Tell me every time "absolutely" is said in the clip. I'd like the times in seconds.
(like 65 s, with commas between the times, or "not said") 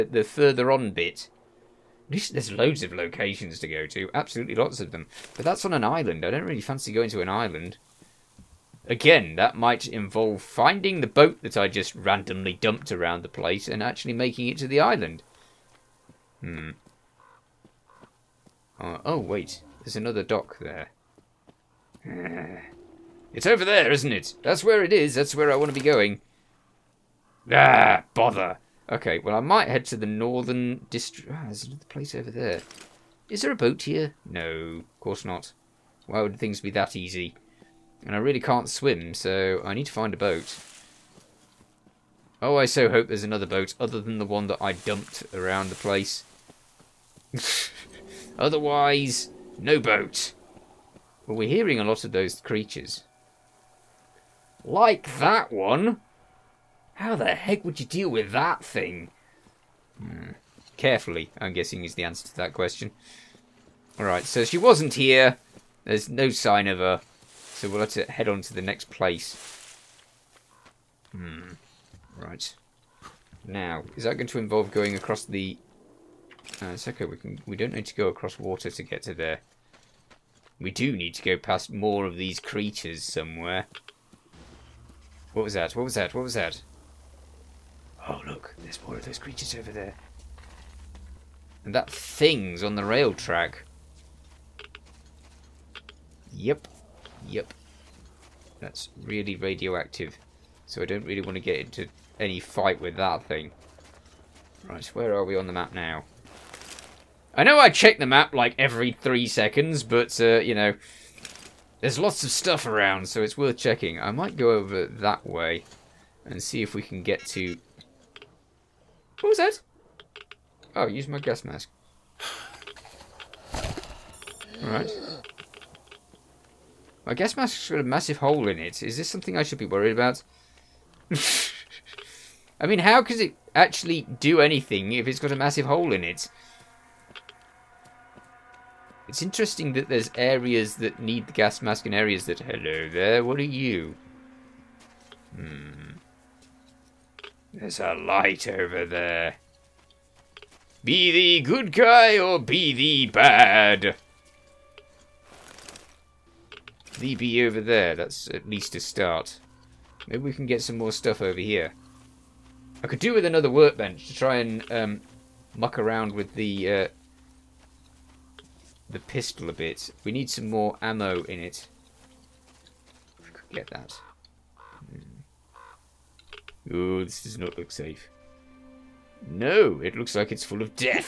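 4 s.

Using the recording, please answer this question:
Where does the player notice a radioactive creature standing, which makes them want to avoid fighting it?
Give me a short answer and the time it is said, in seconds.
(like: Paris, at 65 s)
On the rail track, at 92 s.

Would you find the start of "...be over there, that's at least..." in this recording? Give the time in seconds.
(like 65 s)
157 s.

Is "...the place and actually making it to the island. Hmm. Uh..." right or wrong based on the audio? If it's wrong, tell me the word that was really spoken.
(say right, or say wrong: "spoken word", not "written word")
right.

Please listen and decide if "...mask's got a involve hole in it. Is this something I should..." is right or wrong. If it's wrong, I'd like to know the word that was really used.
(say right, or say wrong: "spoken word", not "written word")
wrong: "massive", not "involve".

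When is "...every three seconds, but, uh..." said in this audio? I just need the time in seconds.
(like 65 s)
108 s.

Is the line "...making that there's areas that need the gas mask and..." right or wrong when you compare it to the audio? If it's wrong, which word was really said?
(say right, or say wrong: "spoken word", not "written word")
wrong: "interesting", not "making".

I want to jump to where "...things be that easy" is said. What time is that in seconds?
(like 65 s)
36 s.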